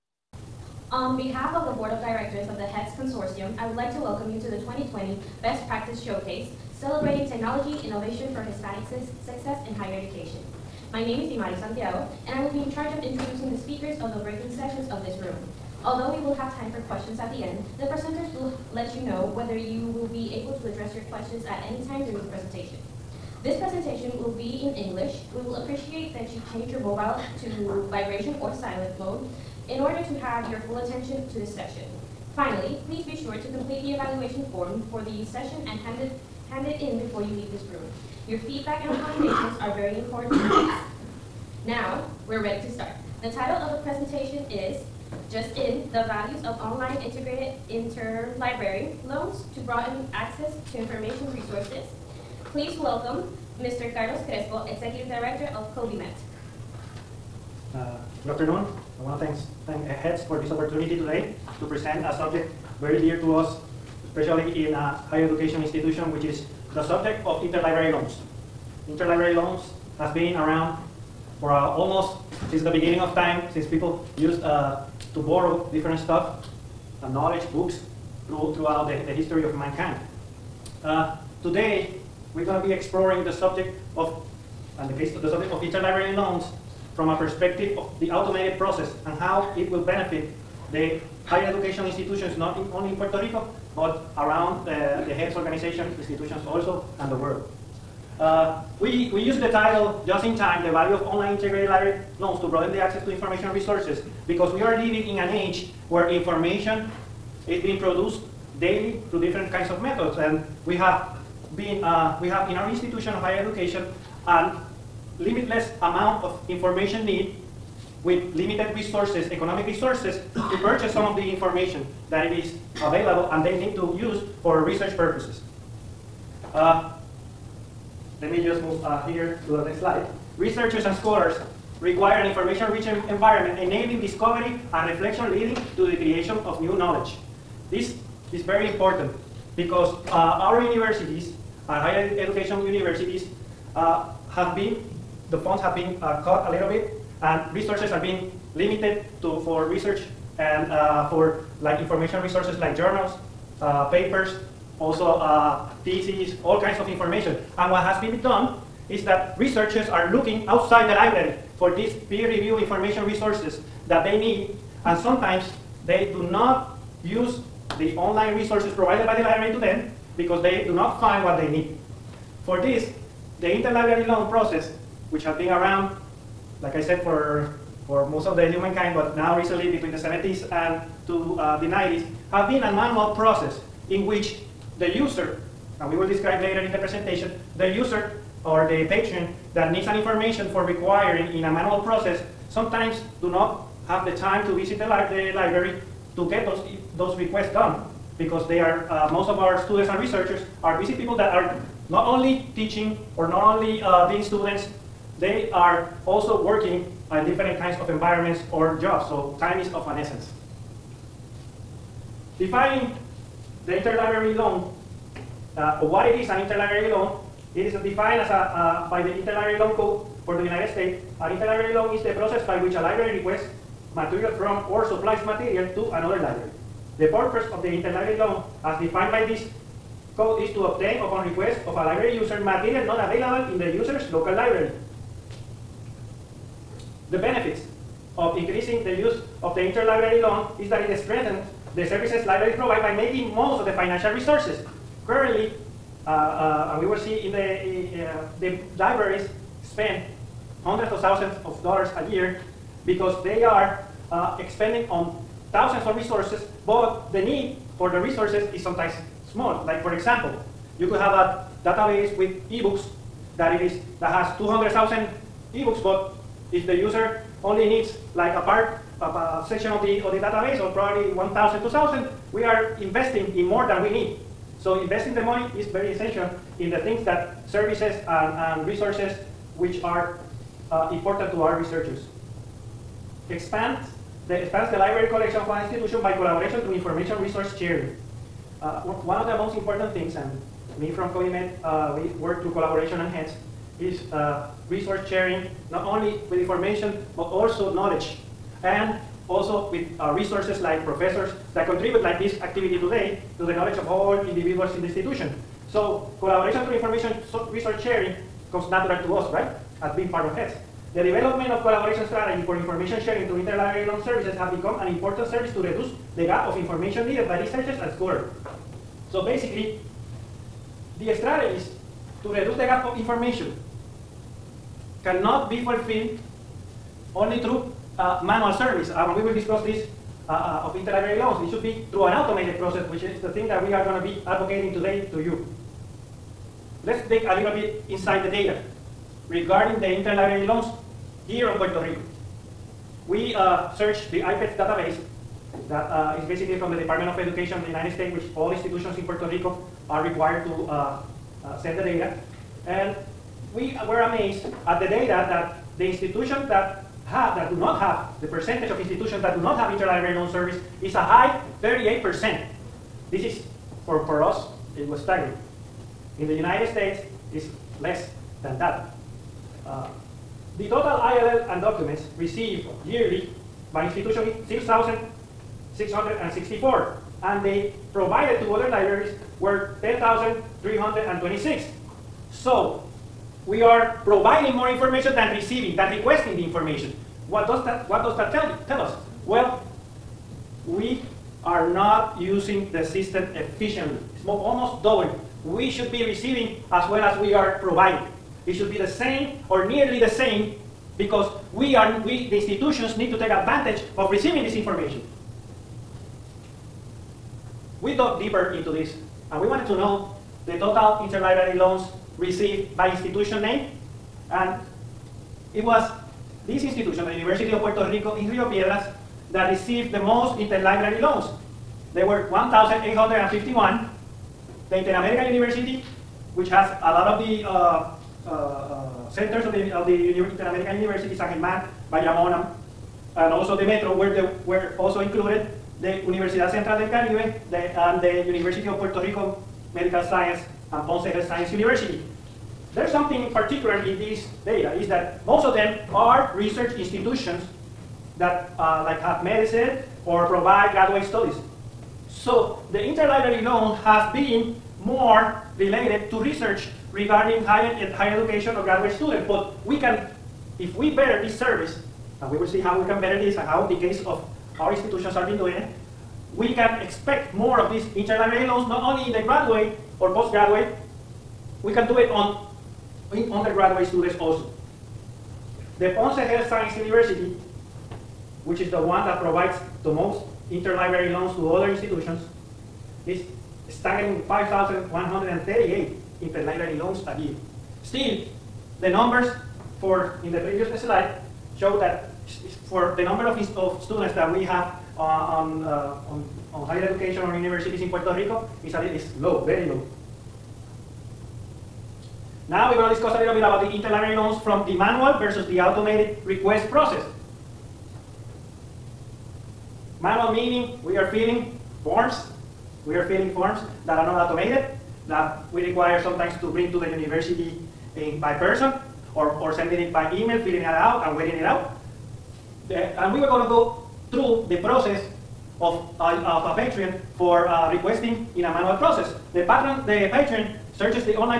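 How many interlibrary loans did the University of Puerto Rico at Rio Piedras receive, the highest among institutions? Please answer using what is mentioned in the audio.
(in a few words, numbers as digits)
1,851.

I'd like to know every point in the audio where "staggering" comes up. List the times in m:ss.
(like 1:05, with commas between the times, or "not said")
6:05, 8:03.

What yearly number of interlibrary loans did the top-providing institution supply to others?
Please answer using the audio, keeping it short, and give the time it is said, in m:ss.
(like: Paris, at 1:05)
5,138, at 8:04.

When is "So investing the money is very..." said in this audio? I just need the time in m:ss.
4:34.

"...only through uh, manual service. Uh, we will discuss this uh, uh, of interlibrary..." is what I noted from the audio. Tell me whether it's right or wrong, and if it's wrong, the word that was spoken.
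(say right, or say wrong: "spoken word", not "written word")
right.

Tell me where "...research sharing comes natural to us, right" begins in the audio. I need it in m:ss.
5:07.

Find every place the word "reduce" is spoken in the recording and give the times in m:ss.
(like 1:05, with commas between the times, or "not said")
5:15, 5:22.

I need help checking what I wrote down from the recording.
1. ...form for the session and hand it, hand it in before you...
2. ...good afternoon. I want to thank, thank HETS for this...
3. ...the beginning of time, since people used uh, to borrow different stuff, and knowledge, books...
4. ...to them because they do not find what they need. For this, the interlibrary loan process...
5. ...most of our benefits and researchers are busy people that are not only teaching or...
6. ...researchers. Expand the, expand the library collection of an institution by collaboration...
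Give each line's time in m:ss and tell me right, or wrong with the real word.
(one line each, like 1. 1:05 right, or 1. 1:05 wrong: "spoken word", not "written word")
1. 0:34 right
2. 0:58 right
3. 1:12 right
4. 2:49 right
5. 3:19 wrong: "students", not "benefits"
6. 4:41 right.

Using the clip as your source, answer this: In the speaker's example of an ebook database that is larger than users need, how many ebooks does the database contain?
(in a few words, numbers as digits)
200,000.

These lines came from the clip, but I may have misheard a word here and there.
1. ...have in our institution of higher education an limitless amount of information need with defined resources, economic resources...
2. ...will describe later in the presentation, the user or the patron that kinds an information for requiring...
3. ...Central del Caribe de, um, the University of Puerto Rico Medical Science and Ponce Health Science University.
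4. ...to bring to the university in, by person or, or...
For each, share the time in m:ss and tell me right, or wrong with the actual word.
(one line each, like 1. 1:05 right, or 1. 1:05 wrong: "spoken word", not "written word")
1. 1:52 wrong: "limited", not "defined"
2. 3:05 wrong: "needs", not "kinds"
3. 7:16 right
4. 8:36 right.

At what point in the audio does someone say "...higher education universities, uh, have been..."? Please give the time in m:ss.
2:21.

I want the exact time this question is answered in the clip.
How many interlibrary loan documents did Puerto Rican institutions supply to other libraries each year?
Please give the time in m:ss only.
6:19.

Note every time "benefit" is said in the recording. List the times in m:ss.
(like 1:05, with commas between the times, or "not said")
1:29, 3:57.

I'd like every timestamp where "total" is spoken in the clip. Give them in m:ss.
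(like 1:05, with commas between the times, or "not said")
6:10, 6:50.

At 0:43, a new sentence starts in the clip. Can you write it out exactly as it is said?
The title of the presentation is Just In, the Values of Online Integrated Interlibrary Loans to Broaden Access to Information Resources.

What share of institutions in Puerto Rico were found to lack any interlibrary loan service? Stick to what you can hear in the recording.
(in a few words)
38%.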